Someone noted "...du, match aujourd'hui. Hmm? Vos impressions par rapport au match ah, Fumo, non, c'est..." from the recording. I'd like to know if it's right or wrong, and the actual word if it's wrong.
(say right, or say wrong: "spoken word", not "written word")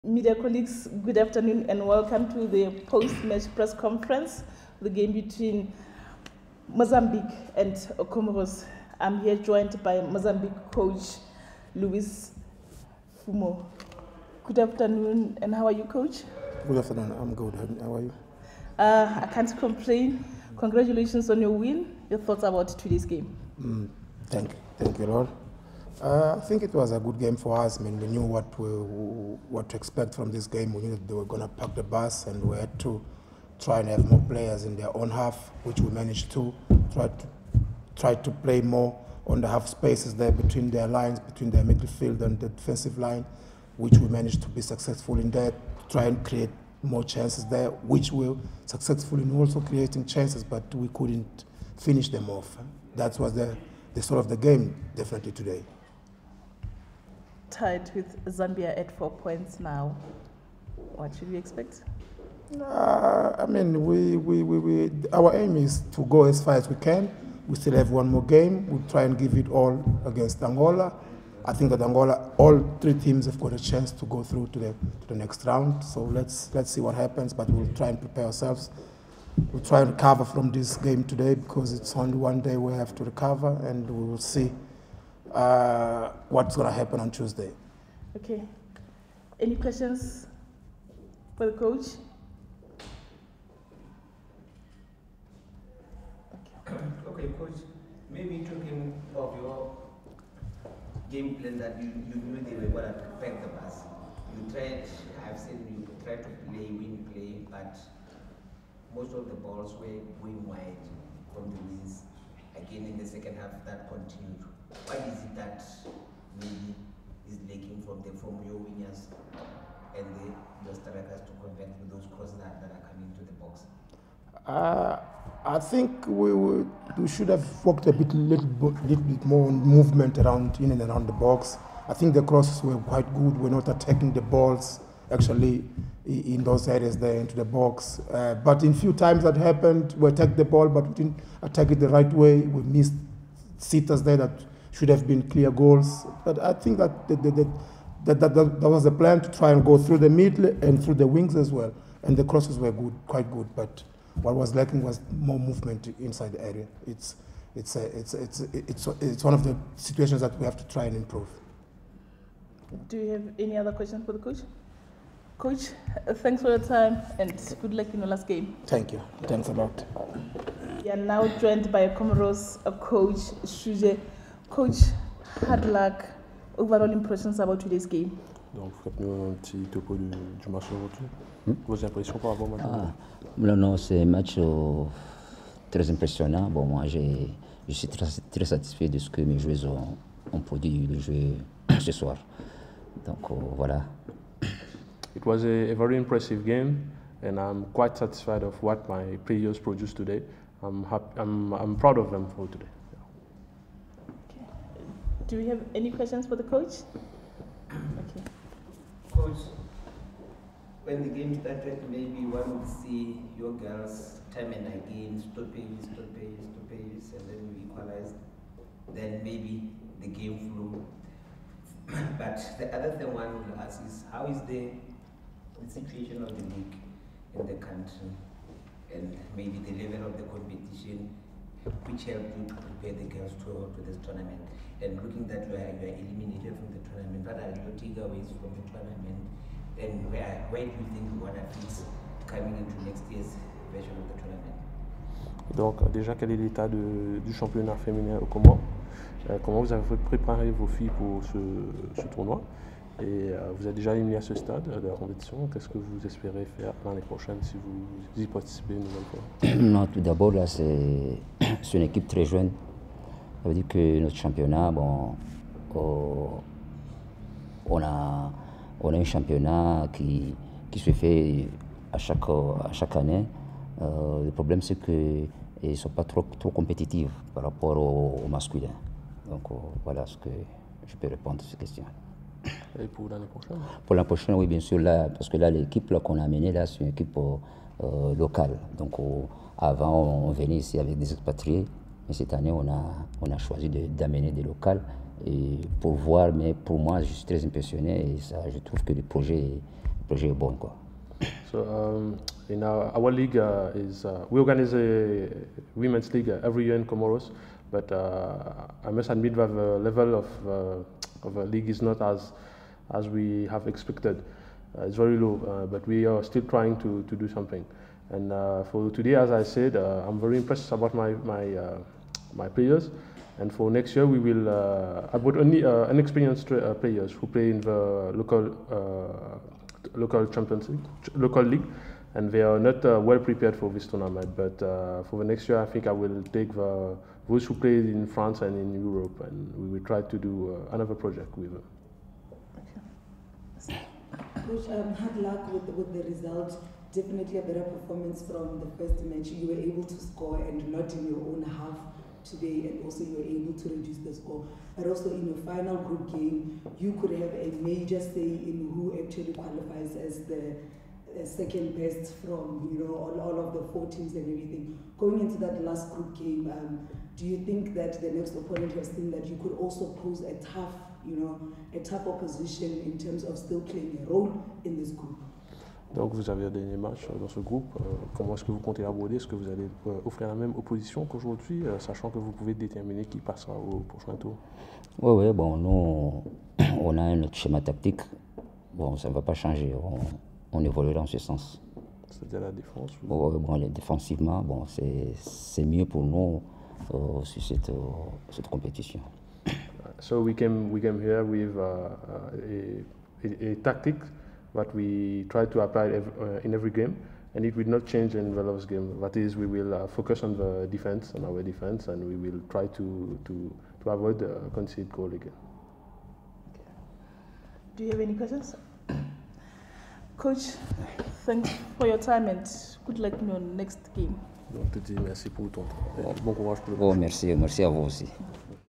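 wrong: "Non", not "Fumo".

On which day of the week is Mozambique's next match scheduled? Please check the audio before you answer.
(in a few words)
Tuesday.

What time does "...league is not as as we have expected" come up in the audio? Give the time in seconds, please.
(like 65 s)
311 s.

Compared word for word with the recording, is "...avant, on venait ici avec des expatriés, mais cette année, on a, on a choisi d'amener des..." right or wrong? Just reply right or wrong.
right.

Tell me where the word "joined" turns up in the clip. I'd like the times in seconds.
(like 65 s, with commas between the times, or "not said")
9 s, 171 s.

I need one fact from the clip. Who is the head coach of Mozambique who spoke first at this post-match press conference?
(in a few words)
Luis Fumo.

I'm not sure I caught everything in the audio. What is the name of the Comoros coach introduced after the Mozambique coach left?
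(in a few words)
Shuje.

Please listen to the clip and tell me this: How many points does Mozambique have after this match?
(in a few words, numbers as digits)
4.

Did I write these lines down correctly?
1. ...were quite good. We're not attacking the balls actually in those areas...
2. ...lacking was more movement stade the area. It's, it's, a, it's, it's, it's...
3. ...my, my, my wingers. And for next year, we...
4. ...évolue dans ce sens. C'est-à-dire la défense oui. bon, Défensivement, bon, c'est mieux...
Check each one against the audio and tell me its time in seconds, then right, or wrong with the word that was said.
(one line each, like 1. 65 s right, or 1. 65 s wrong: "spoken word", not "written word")
1. 132 s right
2. 154 s wrong: "inside", not "stade"
3. 320 s wrong: "players", not "wingers"
4. 390 s right.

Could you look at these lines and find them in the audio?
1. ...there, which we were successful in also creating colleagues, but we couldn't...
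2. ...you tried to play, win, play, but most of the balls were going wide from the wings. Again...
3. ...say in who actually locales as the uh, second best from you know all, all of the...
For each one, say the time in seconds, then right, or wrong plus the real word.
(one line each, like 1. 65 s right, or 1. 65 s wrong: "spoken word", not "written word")
1. 47 s wrong: "chances", not "colleagues"
2. 105 s right
3. 357 s wrong: "qualifies", not "locales".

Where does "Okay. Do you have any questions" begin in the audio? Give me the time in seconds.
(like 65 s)
416 s.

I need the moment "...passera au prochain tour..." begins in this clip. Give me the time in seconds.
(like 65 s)
383 s.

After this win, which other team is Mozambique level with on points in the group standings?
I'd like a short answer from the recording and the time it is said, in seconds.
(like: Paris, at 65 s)
Zambia, at 58 s.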